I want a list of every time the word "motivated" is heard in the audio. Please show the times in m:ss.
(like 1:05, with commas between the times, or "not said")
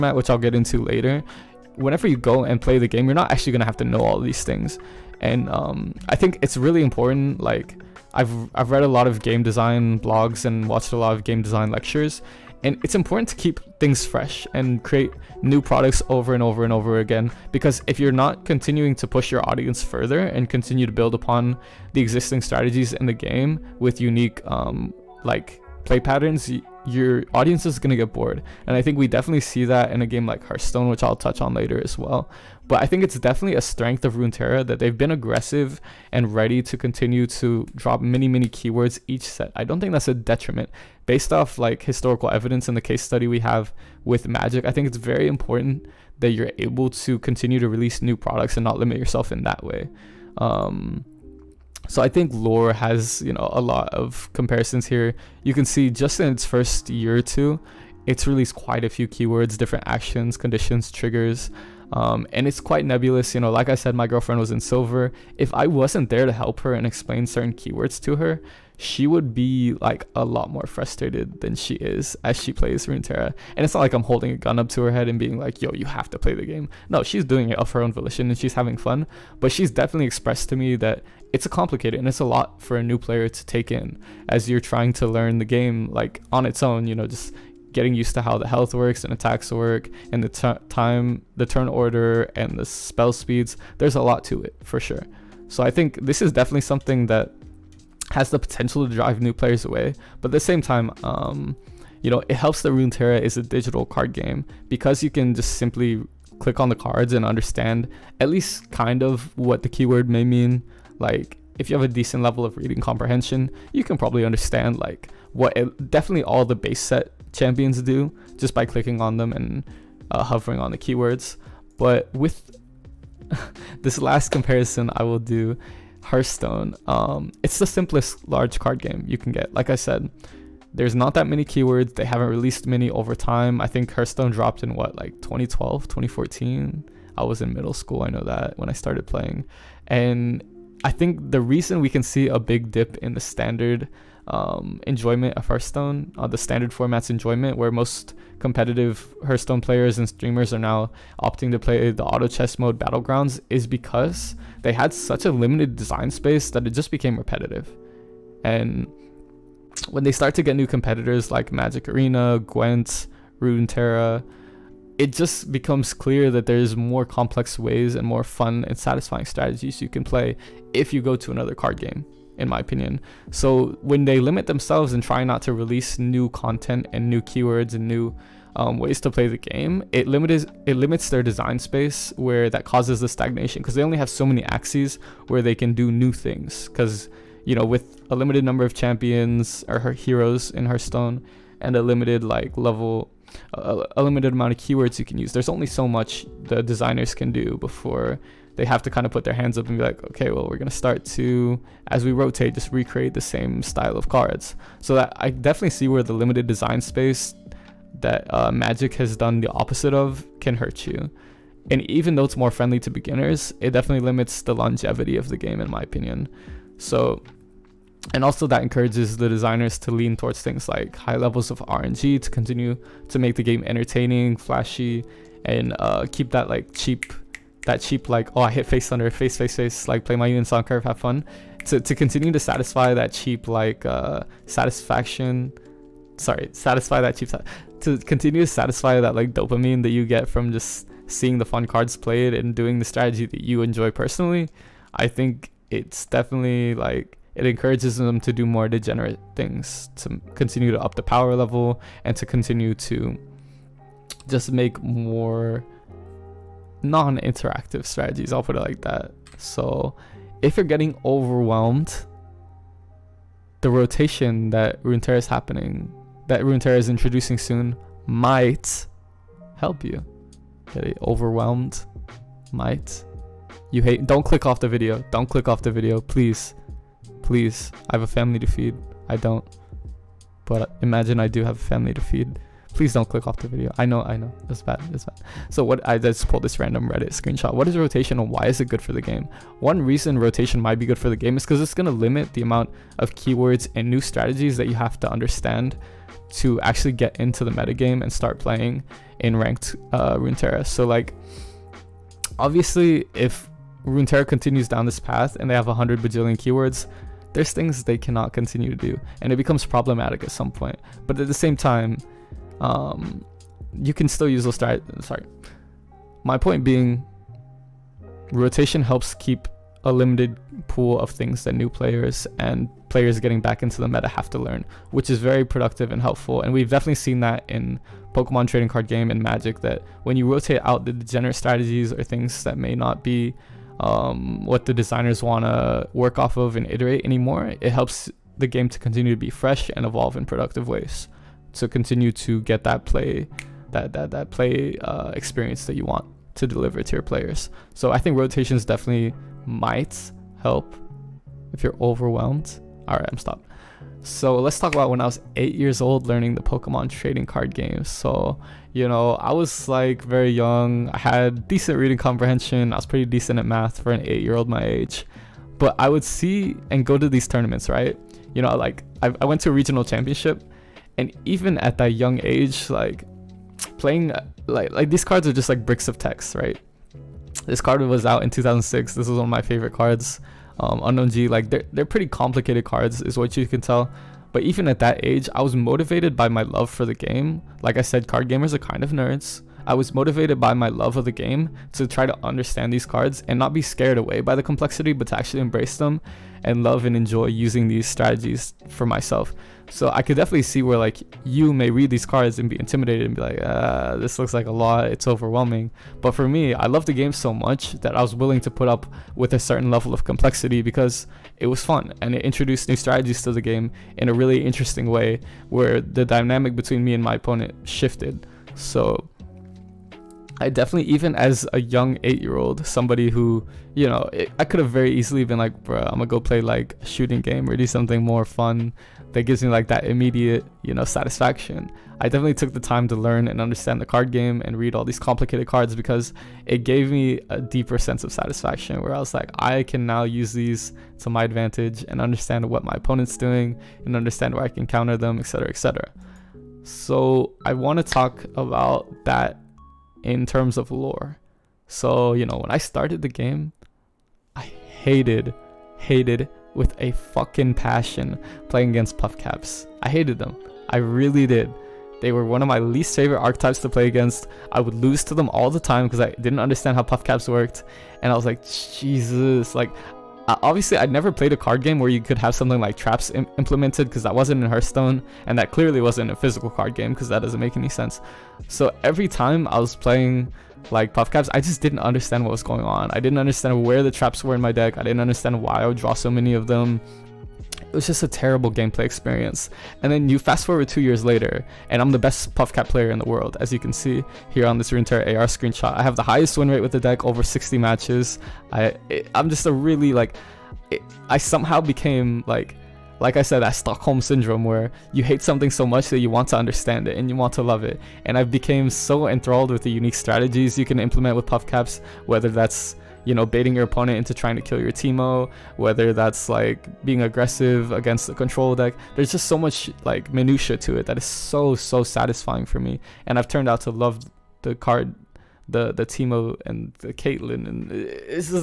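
6:25, 6:29.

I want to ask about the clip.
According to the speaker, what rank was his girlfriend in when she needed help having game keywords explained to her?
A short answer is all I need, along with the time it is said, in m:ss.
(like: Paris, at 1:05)
Silver, at 1:04.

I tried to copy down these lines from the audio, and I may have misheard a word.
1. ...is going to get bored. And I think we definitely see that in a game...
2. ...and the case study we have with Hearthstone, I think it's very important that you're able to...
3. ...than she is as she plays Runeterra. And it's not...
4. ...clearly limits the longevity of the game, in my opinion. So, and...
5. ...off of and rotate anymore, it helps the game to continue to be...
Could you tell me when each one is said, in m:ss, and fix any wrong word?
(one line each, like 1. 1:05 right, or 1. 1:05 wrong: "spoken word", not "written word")
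1. 0:27 right
2. 0:42 wrong: "Magic", not "Hearthstone"
3. 1:11 right
4. 3:33 wrong: "definitely", not "clearly"
5. 5:36 wrong: "iterate", not "rotate".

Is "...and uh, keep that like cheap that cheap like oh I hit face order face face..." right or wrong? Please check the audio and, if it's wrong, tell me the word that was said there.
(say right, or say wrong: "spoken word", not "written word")
wrong: "thunder", not "order".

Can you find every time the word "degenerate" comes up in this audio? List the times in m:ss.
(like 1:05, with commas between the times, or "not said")
4:08, 5:30.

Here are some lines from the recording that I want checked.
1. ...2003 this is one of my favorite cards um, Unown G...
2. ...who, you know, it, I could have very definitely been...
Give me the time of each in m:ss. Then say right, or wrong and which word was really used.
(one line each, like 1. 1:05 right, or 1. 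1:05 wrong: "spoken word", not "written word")
1. 6:18 wrong: "2006", not "2003"
2. 7:03 wrong: "easily", not "definitely".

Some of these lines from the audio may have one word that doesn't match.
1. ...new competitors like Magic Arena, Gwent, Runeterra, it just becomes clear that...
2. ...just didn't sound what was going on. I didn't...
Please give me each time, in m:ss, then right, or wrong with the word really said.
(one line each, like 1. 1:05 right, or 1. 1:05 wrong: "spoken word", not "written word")
1. 2:40 right
2. 8:01 wrong: "understand", not "sound".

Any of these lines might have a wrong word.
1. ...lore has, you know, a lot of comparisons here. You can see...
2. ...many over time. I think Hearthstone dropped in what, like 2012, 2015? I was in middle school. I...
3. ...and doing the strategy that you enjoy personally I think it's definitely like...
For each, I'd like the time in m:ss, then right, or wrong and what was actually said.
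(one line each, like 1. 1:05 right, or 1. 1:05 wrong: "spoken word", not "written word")
1. 0:52 right
2. 2:12 wrong: "2014", not "2015"
3. 4:02 right.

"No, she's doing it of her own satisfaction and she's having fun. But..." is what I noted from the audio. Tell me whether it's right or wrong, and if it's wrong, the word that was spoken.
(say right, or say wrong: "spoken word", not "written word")
wrong: "volition", not "satisfaction".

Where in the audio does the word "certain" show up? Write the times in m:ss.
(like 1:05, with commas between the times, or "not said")
1:07, 6:49.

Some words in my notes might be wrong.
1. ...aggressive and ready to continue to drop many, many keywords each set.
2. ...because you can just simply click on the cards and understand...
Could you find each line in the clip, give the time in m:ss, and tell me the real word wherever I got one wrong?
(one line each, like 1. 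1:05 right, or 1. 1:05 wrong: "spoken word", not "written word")
1. 0:35 right
2. 1:44 right.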